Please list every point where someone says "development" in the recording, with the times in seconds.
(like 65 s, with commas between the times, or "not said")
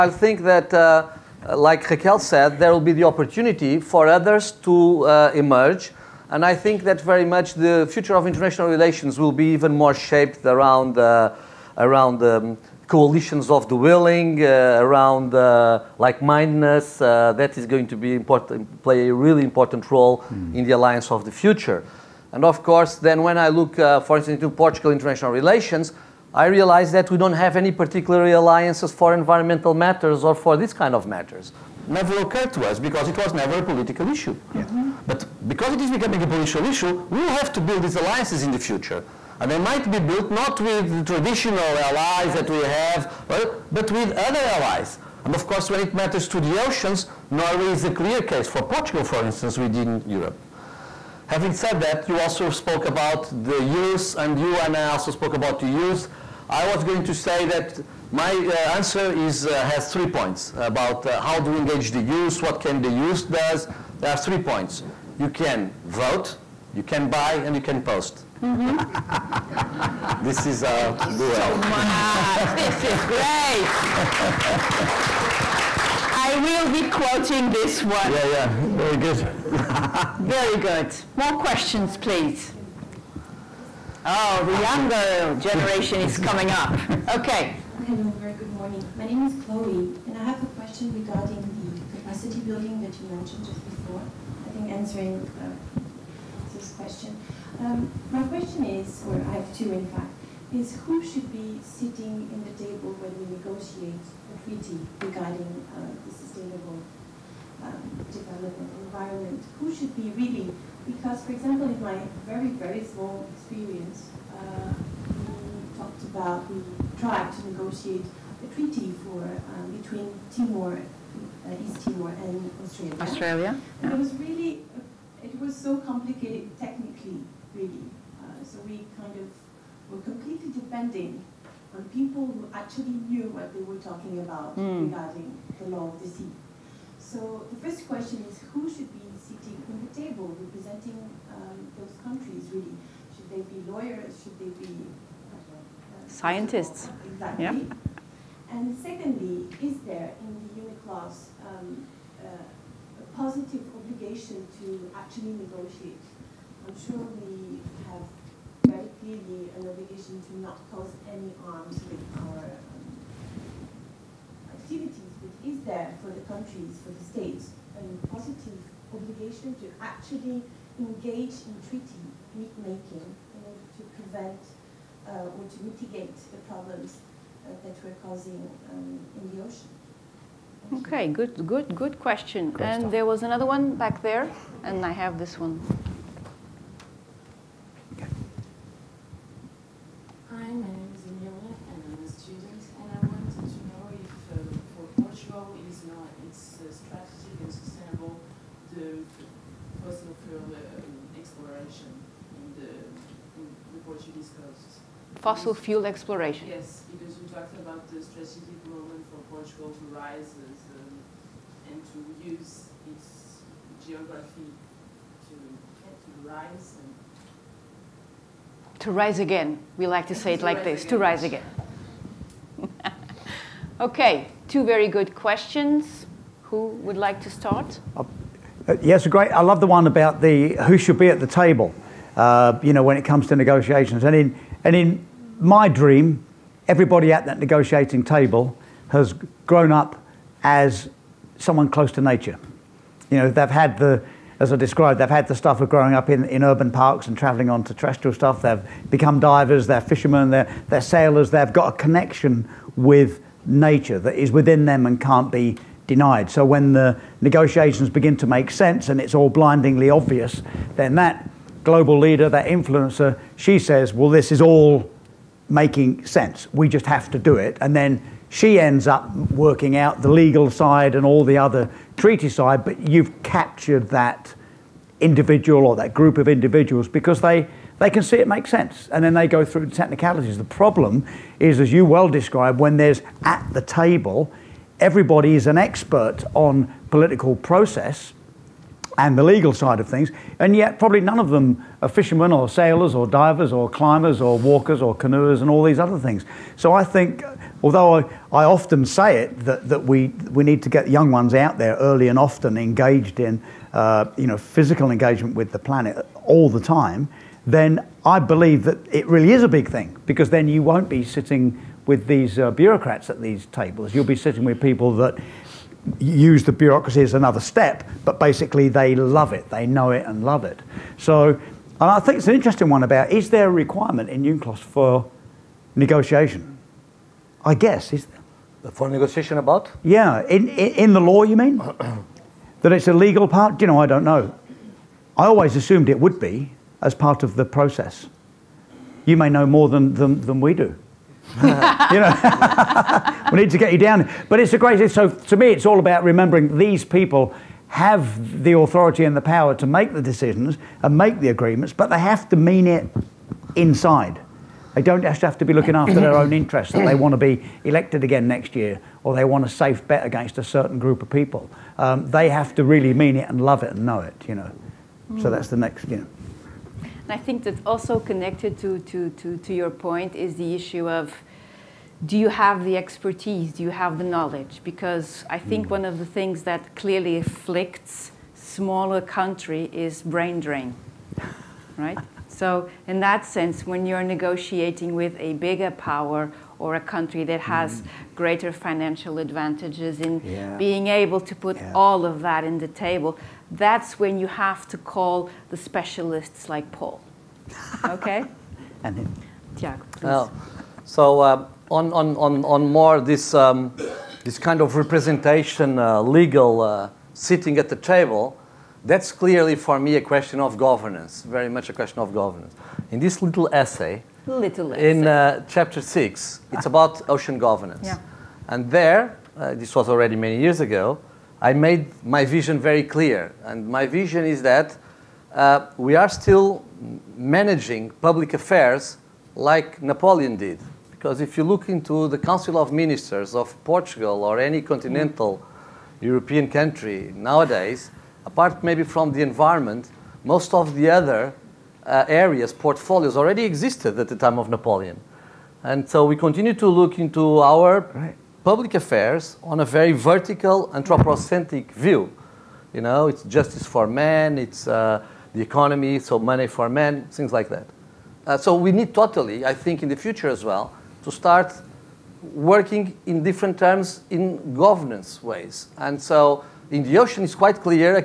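108 s.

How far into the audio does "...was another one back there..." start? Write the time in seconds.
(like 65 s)
183 s.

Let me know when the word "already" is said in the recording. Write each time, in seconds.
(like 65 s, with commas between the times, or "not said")
419 s, 443 s.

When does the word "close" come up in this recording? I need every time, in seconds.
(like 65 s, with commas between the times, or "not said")
241 s.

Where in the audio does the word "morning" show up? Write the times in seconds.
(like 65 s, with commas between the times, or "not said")
88 s.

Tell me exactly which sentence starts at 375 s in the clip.
one of the things that clearly afflicts smaller country is brain drain, right?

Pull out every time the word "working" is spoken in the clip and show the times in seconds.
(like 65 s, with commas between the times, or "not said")
269 s, 462 s.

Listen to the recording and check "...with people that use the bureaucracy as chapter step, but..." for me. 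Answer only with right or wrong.
wrong.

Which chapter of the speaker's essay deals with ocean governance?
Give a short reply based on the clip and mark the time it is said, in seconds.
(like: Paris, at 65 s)
Chapter 6, at 415 s.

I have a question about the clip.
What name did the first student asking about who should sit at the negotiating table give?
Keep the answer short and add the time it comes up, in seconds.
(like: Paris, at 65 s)
Chloe, at 89 s.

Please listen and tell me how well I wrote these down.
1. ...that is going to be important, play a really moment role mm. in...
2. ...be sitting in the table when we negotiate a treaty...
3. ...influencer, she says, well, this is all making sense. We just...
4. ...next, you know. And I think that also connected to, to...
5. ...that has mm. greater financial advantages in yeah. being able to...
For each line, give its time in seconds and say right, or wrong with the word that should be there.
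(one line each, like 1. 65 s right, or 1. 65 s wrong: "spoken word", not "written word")
1. 17 s wrong: "important", not "moment"
2. 101 s right
3. 262 s right
4. 365 s right
5. 387 s right.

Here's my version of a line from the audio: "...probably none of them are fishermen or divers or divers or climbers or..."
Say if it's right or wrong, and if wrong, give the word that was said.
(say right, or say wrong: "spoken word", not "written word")
wrong: "sailors", not "divers".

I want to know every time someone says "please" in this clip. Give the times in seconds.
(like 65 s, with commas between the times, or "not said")
81 s, 399 s.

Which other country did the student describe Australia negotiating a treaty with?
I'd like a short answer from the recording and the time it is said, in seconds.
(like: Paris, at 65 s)
East Timor, at 121 s.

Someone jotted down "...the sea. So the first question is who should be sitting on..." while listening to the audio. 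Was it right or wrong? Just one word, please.
right.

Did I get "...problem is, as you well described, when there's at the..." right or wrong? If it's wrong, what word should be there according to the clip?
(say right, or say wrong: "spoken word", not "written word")
right.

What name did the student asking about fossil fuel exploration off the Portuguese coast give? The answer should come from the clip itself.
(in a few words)
Emilia.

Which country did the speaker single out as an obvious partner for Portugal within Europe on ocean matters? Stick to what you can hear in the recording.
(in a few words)
Norway.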